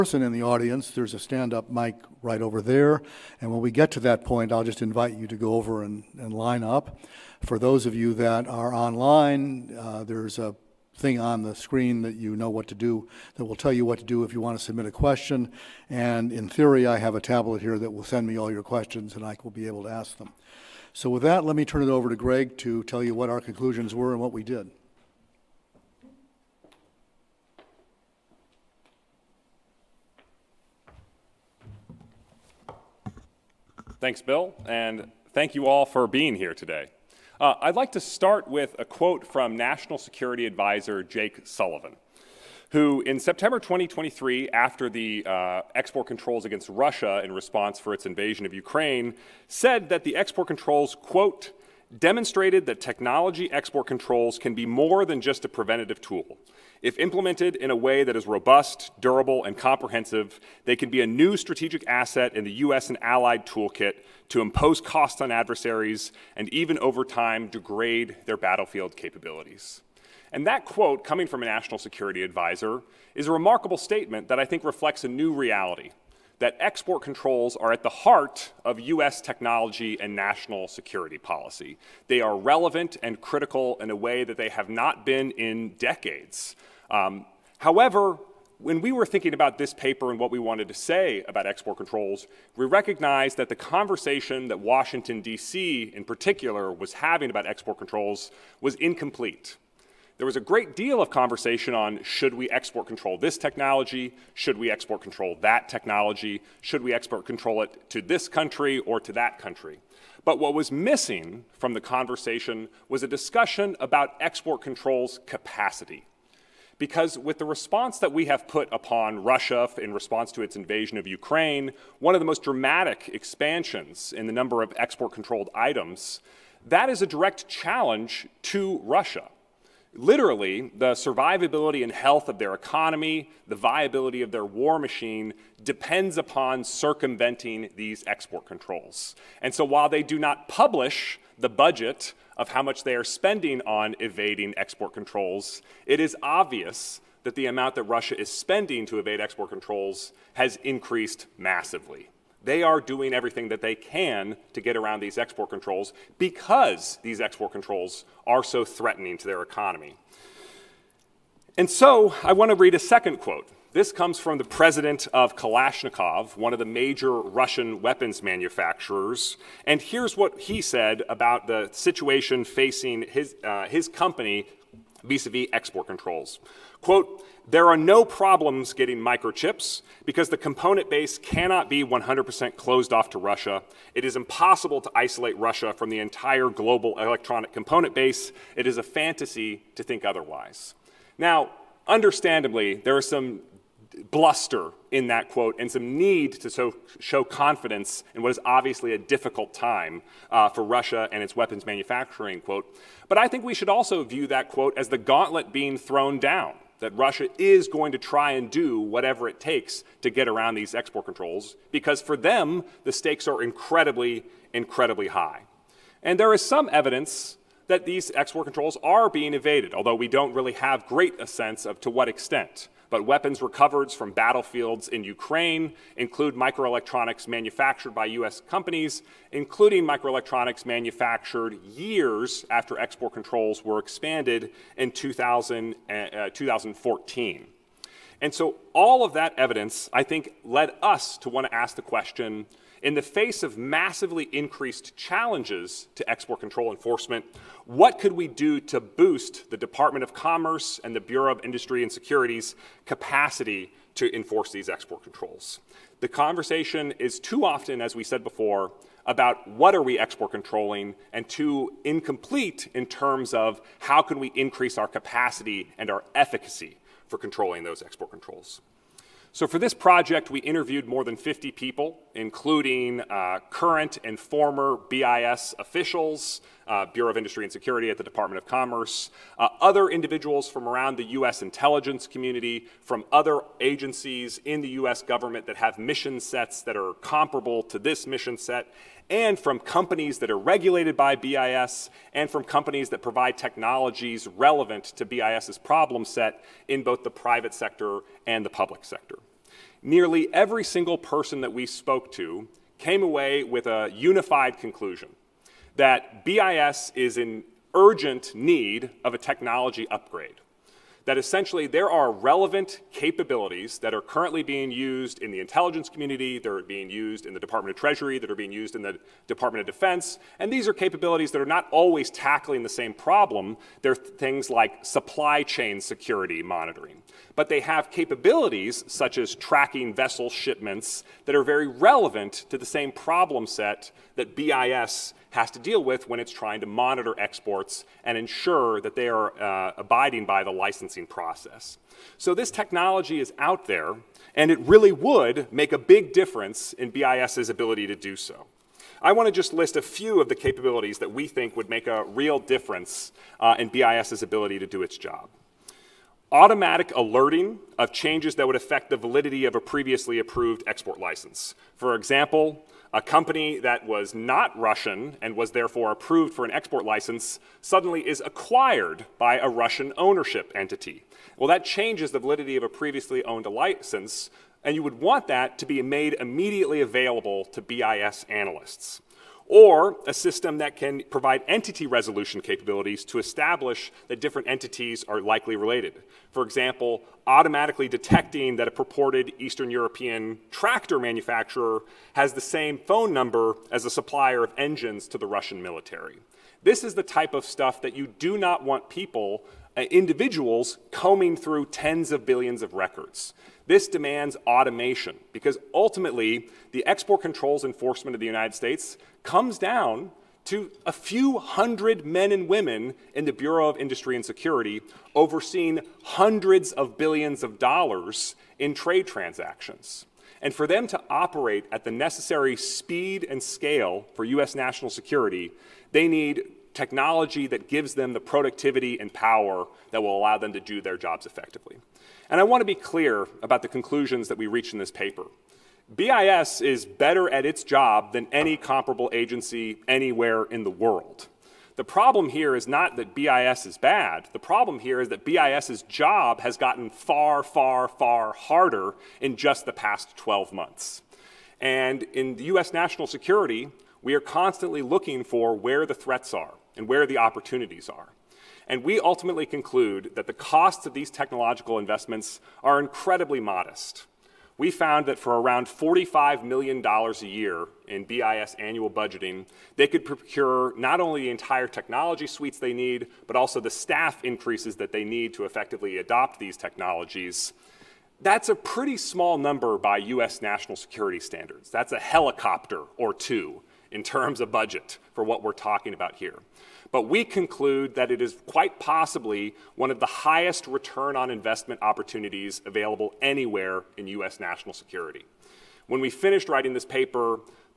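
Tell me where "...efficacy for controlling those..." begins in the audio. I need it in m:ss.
4:26.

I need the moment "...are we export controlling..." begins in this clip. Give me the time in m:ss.
4:19.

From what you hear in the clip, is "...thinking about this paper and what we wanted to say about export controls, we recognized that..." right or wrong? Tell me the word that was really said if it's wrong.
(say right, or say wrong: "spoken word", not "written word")
right.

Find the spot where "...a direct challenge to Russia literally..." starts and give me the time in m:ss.
2:06.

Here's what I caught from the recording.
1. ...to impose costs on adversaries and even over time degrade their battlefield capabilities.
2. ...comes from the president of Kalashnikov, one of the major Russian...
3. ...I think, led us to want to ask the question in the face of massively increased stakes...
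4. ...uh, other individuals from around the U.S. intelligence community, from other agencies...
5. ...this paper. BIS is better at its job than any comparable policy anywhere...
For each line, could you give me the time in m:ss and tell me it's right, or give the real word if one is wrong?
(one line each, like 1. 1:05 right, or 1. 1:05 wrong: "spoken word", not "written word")
1. 1:04 right
2. 2:43 right
3. 3:59 wrong: "challenges", not "stakes"
4. 4:39 right
5. 7:14 wrong: "agency", not "policy".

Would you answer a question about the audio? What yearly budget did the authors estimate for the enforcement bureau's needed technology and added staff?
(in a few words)
$45 million.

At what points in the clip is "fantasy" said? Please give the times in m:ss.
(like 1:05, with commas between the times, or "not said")
3:08.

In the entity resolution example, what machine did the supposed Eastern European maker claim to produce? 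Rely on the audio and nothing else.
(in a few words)
tractor.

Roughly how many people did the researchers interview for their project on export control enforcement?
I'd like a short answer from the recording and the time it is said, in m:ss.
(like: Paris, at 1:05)
more than 50, at 4:30.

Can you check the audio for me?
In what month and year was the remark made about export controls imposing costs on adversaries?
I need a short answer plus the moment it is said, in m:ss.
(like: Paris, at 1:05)
September 2023, at 0:43.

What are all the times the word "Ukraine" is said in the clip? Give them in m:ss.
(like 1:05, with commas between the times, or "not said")
0:48, 2:01, 3:45.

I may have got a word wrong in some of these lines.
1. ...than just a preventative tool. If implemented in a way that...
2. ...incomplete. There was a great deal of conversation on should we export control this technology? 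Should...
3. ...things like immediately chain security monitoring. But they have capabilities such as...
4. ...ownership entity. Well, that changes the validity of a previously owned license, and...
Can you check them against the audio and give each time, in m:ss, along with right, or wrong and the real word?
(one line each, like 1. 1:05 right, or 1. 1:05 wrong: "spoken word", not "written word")
1. 0:55 right
2. 1:38 right
3. 5:23 wrong: "supply", not "immediately"
4. 6:09 right.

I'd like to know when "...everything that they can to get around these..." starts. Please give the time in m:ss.
2:33.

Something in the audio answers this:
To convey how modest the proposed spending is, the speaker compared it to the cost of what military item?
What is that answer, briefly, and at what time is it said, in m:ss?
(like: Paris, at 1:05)
a helicopter or two, at 8:01.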